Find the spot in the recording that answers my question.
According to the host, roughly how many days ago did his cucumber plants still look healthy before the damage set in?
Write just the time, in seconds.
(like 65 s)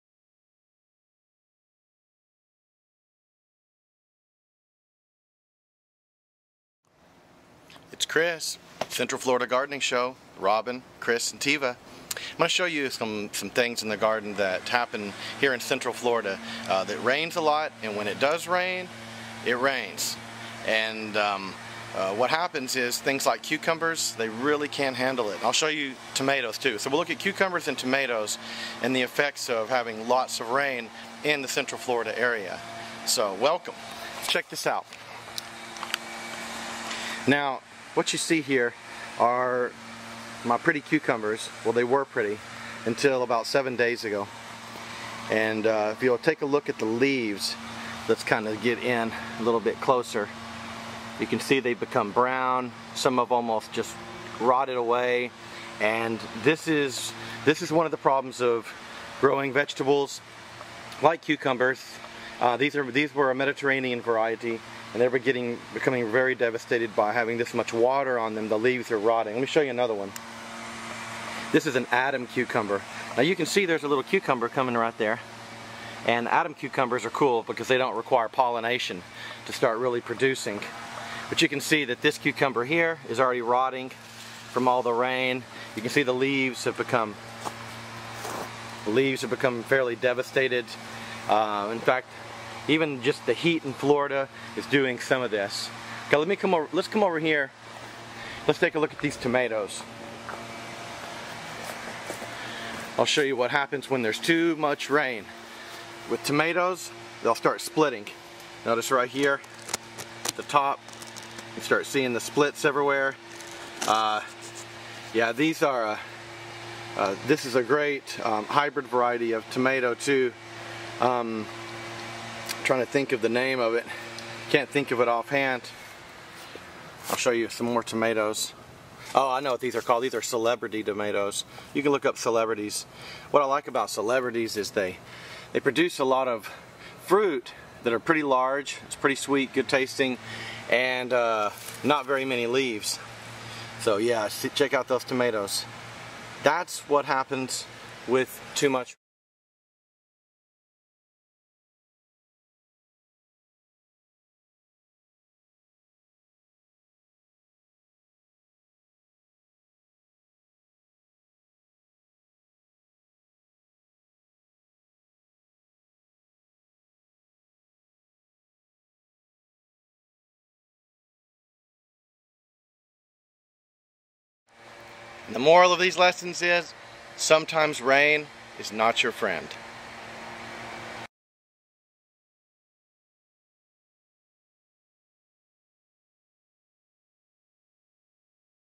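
43 s.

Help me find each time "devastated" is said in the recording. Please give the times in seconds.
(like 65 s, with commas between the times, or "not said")
66 s, 89 s.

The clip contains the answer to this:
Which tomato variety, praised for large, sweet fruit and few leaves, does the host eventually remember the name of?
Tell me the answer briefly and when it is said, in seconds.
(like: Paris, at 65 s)
Celebrity, at 130 s.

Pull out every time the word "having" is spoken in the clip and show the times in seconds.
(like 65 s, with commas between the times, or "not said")
29 s, 67 s.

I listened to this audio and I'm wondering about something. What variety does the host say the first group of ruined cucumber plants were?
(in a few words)
Mediterranean.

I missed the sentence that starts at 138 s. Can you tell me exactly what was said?
It's pretty sweet, good tasting, and uh, not very many leaves.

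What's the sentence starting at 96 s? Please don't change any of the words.
Okay, let me come over, let's come over here.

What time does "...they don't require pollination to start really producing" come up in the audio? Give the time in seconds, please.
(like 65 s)
77 s.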